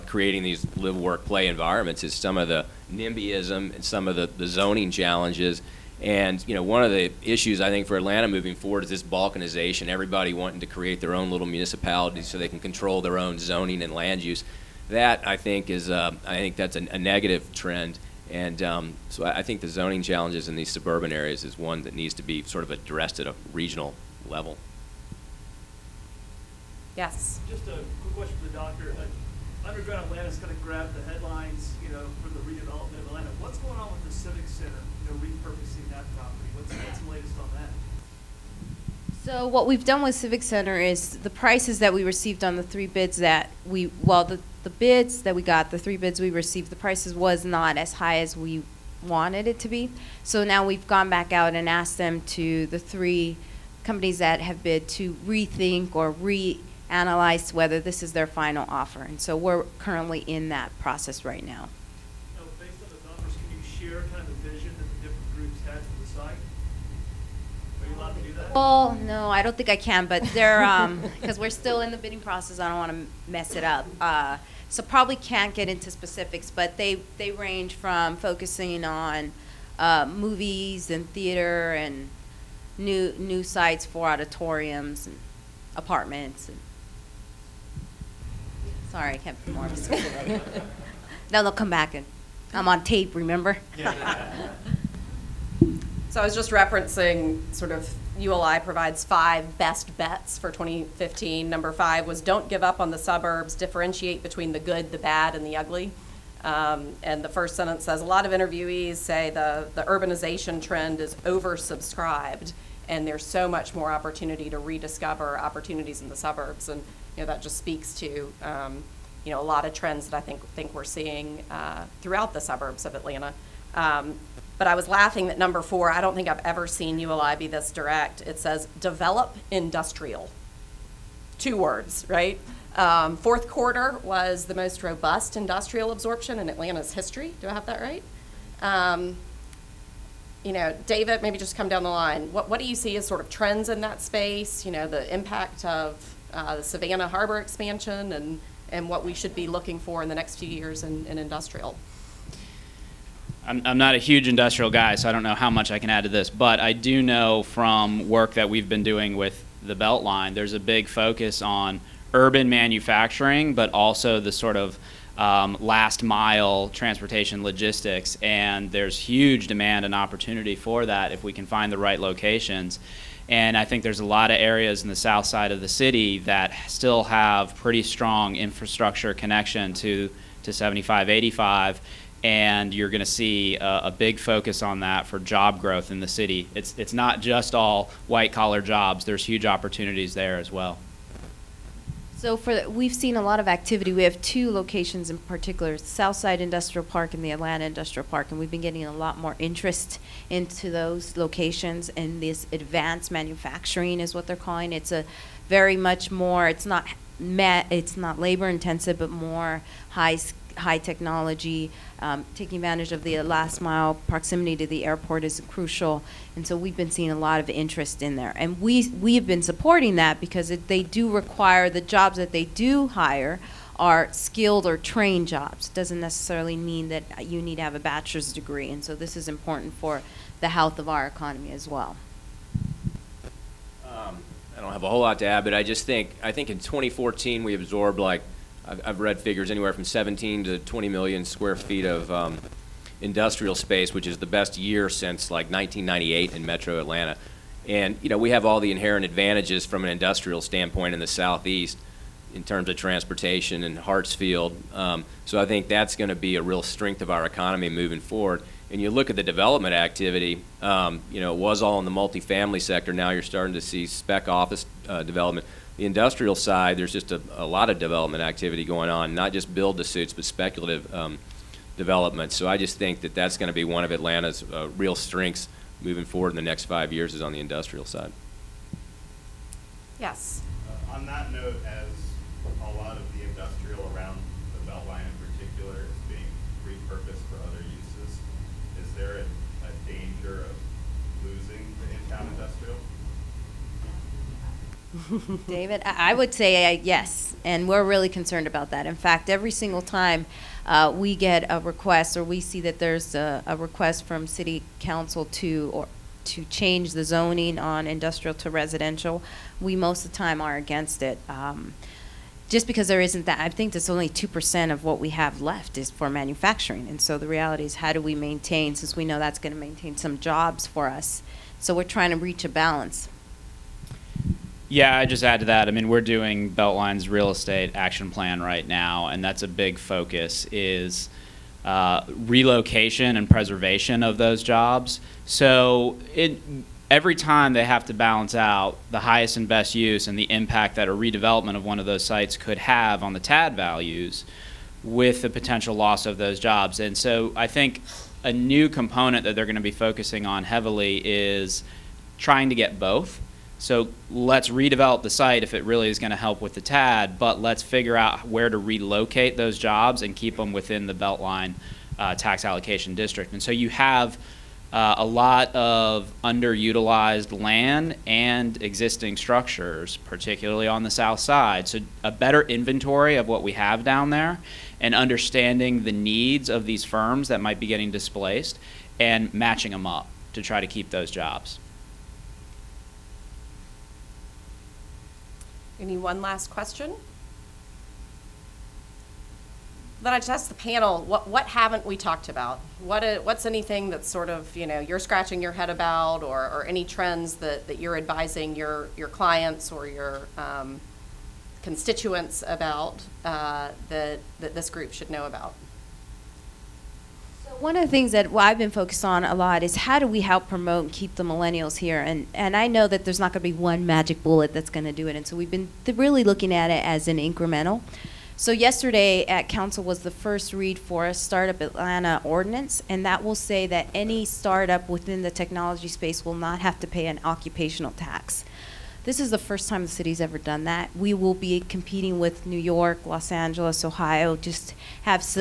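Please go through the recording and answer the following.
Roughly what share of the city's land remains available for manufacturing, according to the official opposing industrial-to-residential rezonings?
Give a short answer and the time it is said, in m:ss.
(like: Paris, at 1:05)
2%, at 5:14.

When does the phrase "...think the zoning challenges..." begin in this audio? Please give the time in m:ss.
0:19.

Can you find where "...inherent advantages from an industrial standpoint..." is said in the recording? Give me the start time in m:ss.
4:08.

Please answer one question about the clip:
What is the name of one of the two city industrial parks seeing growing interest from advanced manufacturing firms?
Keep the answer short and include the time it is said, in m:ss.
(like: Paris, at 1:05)
Southside Industrial Park, at 3:15.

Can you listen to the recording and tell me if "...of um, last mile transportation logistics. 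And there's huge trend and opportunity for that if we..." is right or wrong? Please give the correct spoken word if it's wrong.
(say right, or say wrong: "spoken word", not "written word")
wrong: "demand", not "trend".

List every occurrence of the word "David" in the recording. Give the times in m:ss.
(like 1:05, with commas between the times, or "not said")
2:20, 4:55.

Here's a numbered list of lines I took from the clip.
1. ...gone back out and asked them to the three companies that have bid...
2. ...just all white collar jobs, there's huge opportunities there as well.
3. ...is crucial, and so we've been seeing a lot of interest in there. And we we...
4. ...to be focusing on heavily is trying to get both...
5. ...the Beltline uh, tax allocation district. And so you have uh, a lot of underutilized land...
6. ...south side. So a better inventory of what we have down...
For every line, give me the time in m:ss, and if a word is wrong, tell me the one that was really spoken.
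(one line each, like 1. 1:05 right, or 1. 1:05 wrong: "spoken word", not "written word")
1. 0:50 right
2. 3:07 right
3. 3:35 right
4. 5:49 right
5. 6:00 right
6. 6:10 right.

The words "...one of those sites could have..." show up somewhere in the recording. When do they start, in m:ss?
5:41.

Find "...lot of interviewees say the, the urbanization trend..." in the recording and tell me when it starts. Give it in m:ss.
1:48.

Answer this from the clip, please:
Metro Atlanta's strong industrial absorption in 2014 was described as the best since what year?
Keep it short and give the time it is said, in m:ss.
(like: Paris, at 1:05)
1998, at 4:05.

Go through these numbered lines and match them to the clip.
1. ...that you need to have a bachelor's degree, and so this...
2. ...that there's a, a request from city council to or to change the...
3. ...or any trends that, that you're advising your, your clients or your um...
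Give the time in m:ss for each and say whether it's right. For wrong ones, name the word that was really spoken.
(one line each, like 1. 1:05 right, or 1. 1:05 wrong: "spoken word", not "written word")
1. 3:46 right
2. 5:02 right
3. 6:36 right.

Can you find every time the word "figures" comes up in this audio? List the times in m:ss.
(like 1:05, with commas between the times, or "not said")
3:59, 5:57.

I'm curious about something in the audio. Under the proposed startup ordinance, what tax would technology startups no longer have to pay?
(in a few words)
occupational tax.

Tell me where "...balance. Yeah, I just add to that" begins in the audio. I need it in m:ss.
5:22.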